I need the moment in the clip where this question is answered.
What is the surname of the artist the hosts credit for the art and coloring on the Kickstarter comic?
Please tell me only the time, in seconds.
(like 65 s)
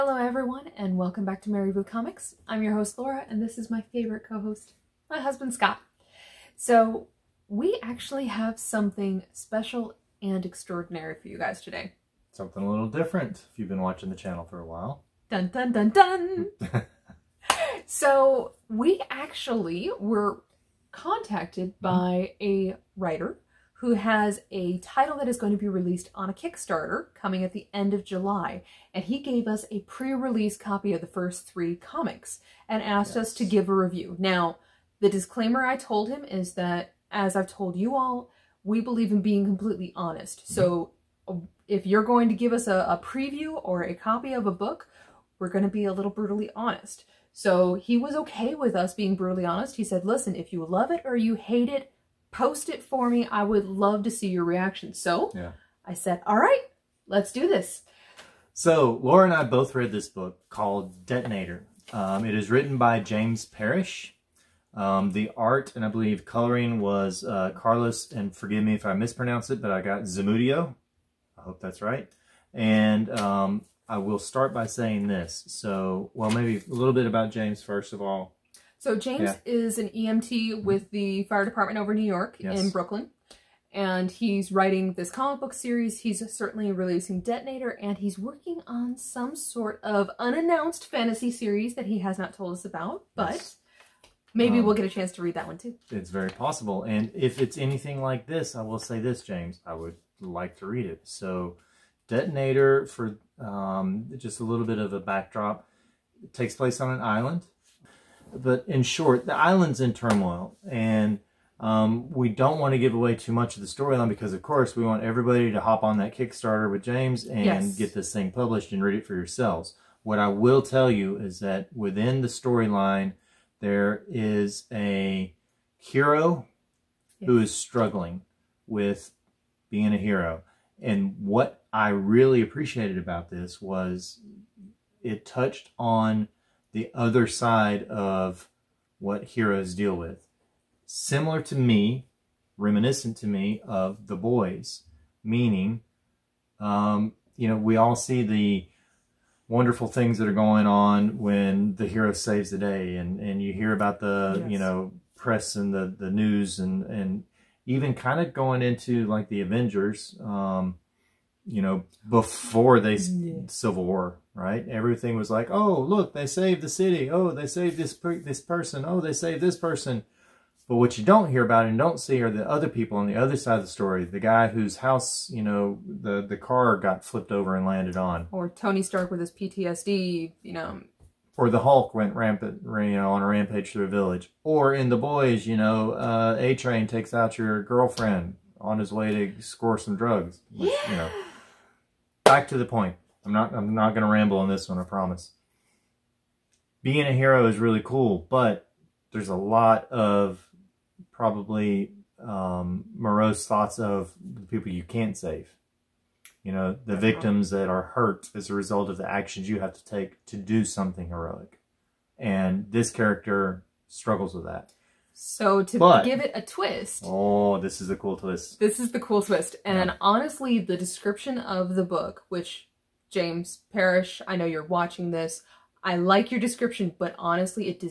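70 s.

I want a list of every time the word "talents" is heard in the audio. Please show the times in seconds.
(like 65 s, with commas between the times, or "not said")
not said.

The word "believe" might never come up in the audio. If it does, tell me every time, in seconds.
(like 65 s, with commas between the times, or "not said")
38 s, 65 s.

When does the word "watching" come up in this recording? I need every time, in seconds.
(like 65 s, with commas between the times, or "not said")
13 s, 224 s.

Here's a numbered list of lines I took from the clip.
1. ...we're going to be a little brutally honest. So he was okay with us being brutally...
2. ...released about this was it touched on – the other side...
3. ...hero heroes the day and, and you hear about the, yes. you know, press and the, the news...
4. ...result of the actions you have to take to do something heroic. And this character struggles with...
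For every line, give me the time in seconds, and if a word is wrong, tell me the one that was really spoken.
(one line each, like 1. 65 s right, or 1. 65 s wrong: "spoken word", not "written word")
1. 45 s right
2. 132 s wrong: "appreciated", not "released"
3. 151 s wrong: "saves", not "heroes"
4. 208 s right.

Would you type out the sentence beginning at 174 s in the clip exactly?
The guy whose house, you know, the, the car got flipped over and landed on.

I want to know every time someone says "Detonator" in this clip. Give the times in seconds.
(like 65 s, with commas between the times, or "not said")
61 s, 87 s, 102 s.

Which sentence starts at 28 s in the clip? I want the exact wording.
And he gave us a pre-release copy of the first three comics and asked yes.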